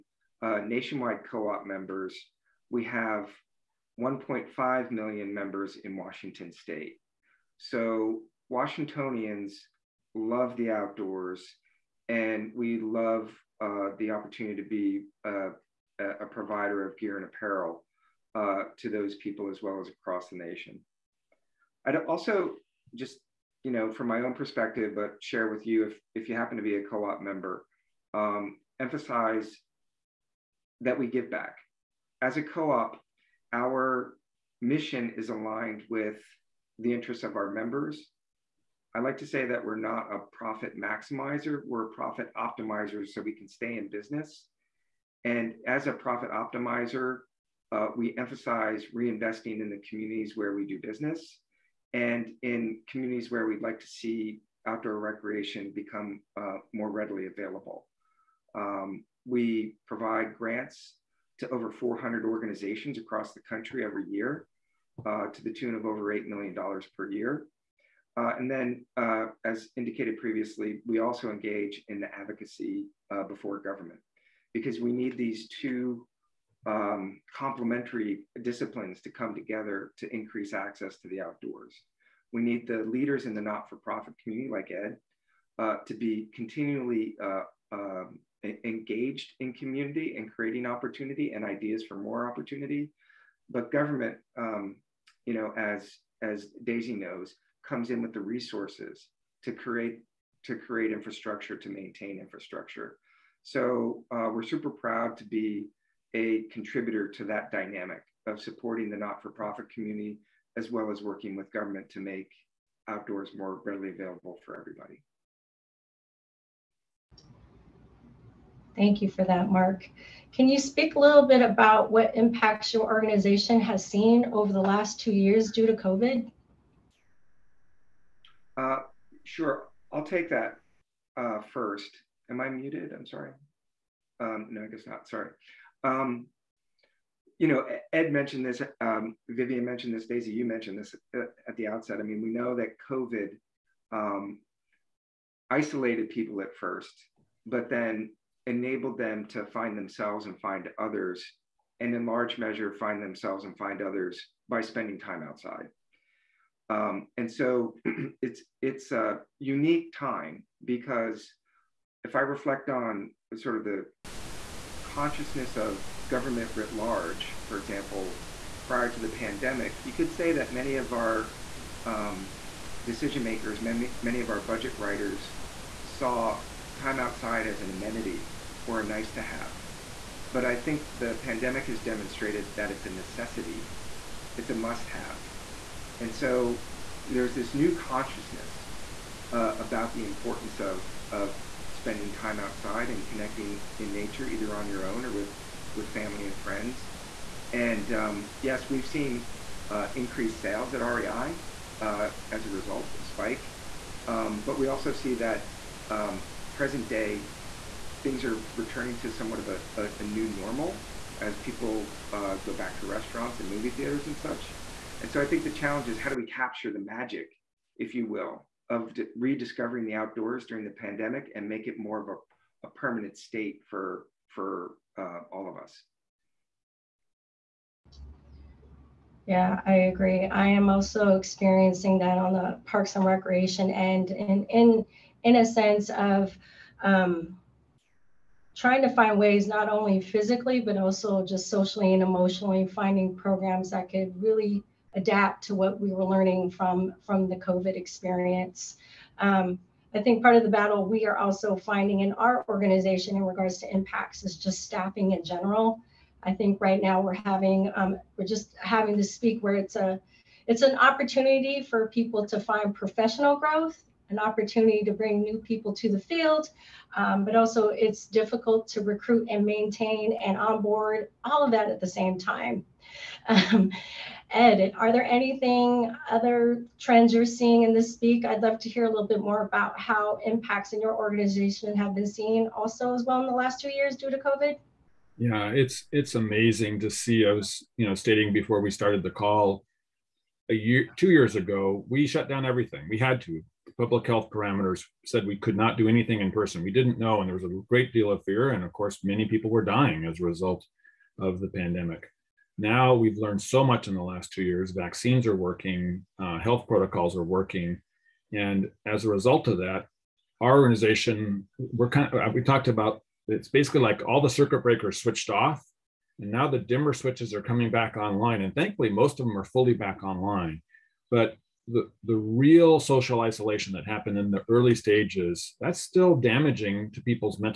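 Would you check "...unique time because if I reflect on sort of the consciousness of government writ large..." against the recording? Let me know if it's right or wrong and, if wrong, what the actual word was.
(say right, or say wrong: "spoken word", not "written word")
right.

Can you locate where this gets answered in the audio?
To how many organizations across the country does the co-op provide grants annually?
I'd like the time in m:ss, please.
1:01.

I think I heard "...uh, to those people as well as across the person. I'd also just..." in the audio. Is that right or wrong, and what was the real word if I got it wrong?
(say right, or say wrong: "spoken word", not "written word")
wrong: "nation", not "person".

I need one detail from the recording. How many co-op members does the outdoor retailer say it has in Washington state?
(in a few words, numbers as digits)
1.5 million.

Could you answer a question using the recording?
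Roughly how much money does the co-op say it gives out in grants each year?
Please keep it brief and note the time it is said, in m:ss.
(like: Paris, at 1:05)
Over $8 million, at 1:05.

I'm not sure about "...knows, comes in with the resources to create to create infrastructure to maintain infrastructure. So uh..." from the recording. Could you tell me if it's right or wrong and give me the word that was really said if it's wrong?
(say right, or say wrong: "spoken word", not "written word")
right.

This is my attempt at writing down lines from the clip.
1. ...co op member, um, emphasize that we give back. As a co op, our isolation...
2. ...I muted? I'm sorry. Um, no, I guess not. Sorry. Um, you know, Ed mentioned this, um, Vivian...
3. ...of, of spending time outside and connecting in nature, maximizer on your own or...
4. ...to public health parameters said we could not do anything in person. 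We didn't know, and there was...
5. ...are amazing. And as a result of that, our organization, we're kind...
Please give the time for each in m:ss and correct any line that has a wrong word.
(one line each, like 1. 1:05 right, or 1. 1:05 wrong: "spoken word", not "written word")
1. 0:26 wrong: "mission", not "isolation"
2. 2:12 right
3. 3:10 wrong: "either", not "maximizer"
4. 4:53 right
5. 5:07 wrong: "working", not "amazing".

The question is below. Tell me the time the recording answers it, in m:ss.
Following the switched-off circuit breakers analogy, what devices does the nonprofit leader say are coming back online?
5:16.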